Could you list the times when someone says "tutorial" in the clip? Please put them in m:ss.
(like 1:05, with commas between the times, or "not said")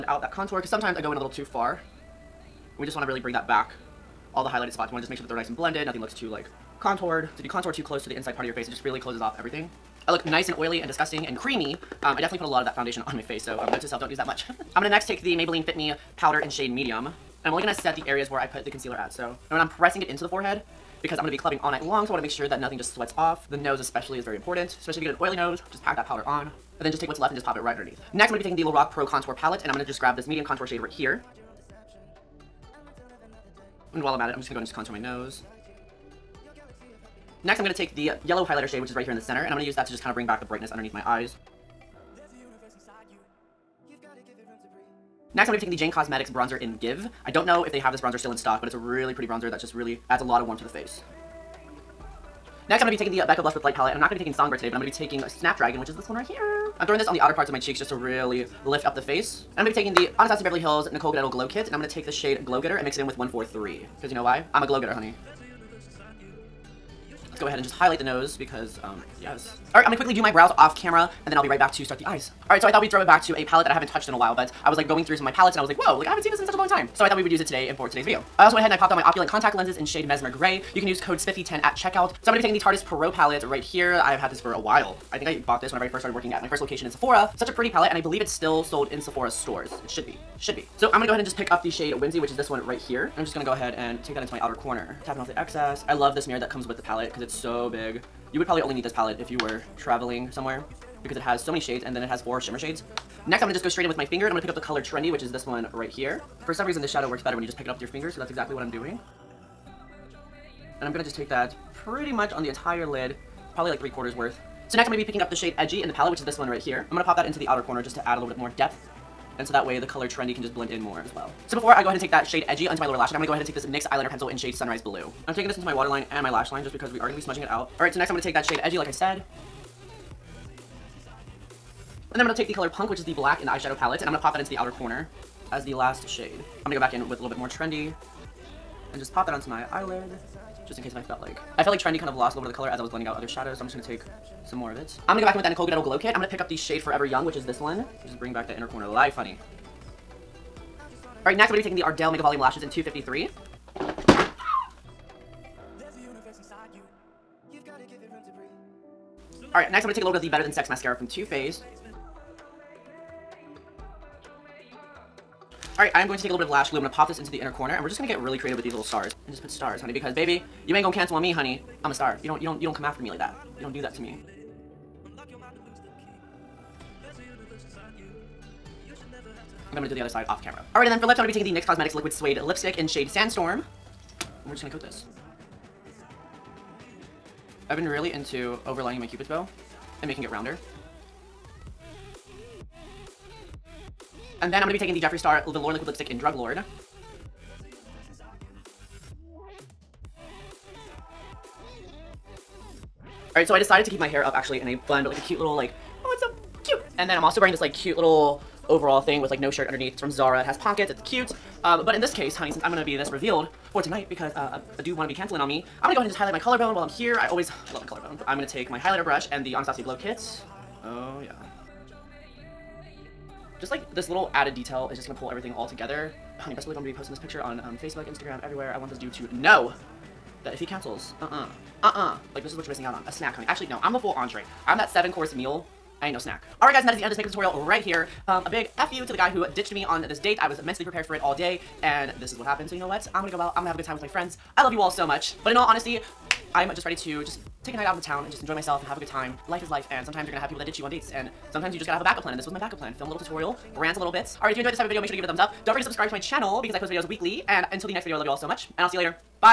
3:57, 4:13.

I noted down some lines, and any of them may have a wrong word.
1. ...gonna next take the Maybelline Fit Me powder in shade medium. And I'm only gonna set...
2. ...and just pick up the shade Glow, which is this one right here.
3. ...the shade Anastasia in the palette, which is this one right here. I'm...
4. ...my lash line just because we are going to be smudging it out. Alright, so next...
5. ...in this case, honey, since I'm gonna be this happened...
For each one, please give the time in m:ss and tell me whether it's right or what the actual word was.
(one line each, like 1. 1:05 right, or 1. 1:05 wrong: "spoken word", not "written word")
1. 0:14 right
2. 1:31 wrong: "Whimsy", not "Glow"
3. 1:55 wrong: "Edgy", not "Anastasia"
4. 2:06 right
5. 3:31 wrong: "revealed", not "happened".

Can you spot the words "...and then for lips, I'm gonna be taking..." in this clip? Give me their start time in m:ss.
3:00.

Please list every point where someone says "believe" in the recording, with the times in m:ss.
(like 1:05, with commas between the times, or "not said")
1:27, 3:46.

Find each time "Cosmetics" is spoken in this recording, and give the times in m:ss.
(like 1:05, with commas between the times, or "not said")
0:45, 3:01.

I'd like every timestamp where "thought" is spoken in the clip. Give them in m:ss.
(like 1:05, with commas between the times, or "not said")
1:12, 1:17.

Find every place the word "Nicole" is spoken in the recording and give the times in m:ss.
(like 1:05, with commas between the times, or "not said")
1:00, 2:25.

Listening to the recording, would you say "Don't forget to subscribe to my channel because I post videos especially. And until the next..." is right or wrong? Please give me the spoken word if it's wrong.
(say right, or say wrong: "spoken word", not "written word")
wrong: "weekly", not "especially".